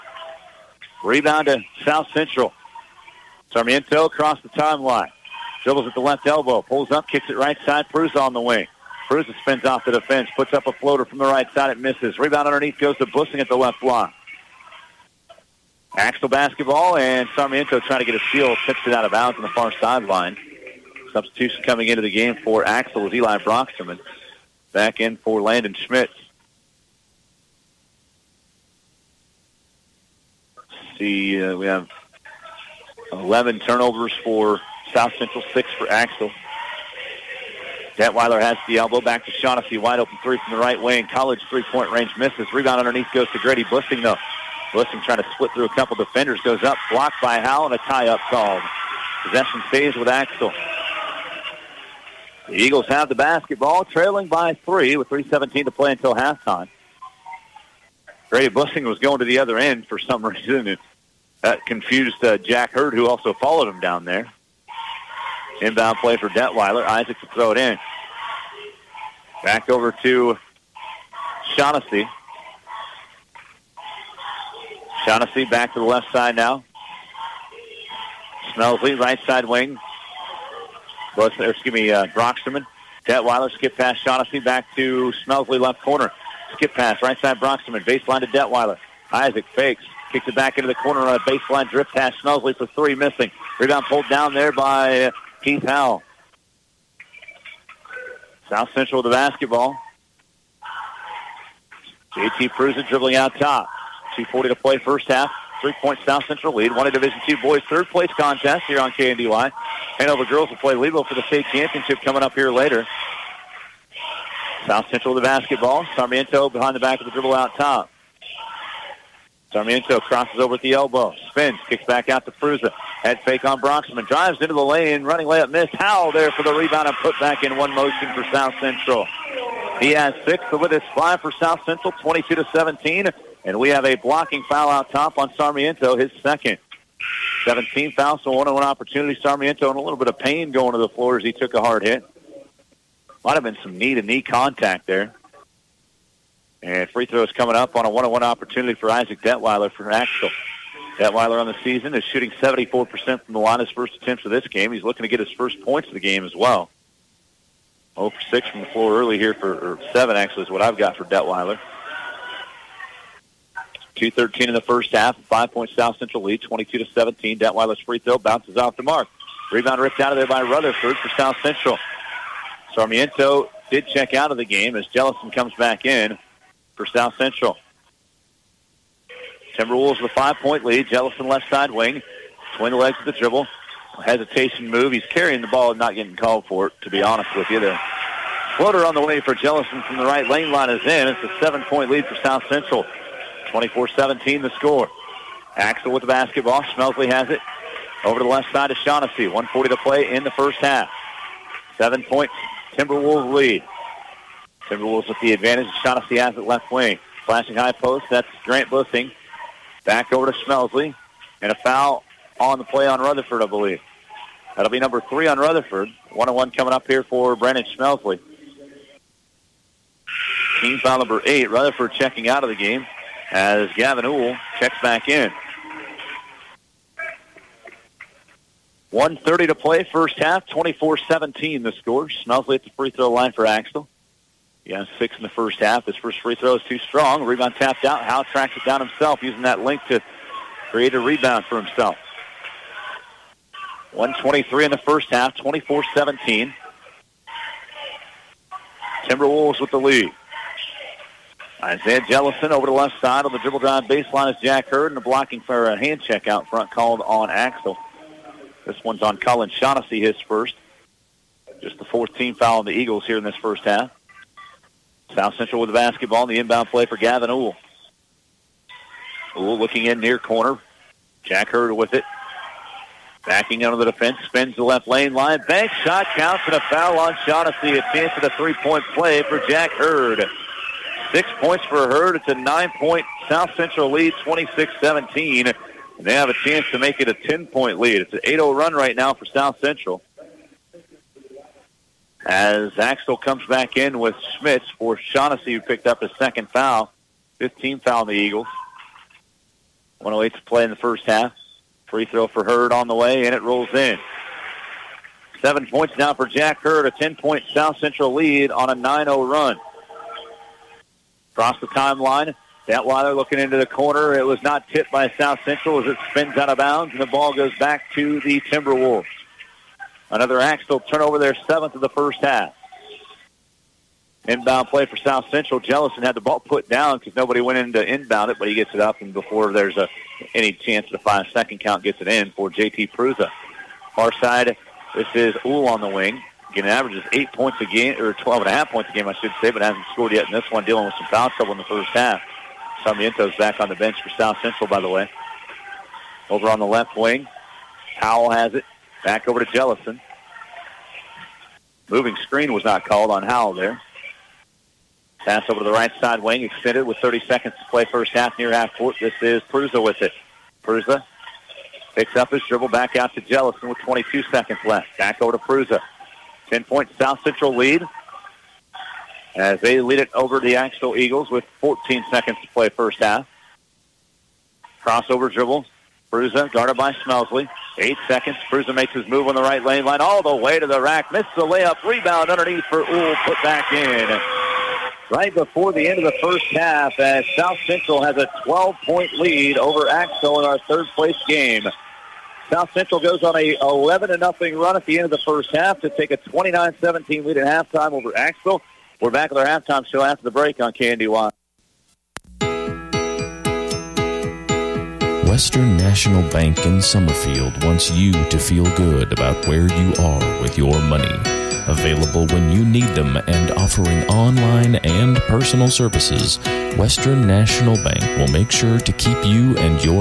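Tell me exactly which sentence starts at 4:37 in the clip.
A chance at a three-point play for Jack Hurd.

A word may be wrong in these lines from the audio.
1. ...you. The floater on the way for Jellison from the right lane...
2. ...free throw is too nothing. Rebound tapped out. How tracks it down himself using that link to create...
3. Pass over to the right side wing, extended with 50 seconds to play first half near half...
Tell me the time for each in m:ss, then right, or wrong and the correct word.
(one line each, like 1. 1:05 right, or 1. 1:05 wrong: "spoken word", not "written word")
1. 3:07 right
2. 3:56 wrong: "strong", not "nothing"
3. 5:55 wrong: "30", not "50".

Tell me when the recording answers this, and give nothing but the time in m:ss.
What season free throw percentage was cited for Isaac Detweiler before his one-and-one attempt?
2:32.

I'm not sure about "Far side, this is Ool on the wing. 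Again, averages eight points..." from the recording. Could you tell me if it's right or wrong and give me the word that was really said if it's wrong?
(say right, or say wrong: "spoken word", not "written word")
right.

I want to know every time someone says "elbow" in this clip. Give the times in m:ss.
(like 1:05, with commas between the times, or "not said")
0:06, 0:38, 2:00.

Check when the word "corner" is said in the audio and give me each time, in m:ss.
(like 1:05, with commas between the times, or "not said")
1:25, 1:30, 4:30, 5:13.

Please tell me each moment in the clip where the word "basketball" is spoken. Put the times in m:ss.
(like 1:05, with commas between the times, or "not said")
0:16, 0:53, 1:39, 1:55, 3:16, 4:25.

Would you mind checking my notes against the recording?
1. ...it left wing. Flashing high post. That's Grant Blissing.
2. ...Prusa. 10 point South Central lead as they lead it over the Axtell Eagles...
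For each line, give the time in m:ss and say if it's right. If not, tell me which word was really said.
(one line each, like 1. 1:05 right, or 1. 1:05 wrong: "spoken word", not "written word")
1. 3:26 right
2. 6:05 right.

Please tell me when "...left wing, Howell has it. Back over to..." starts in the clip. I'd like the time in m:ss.
5:46.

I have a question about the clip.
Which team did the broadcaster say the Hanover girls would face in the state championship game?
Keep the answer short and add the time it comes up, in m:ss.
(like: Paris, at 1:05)
Lebo, at 1:50.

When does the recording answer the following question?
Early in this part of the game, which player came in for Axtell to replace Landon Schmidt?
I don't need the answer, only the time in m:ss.
0:23.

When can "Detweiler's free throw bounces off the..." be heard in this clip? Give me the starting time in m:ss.
2:47.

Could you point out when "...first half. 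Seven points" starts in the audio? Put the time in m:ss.
3:20.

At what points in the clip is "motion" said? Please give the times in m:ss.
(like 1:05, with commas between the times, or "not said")
2:07.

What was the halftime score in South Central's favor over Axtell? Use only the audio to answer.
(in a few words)
29-17.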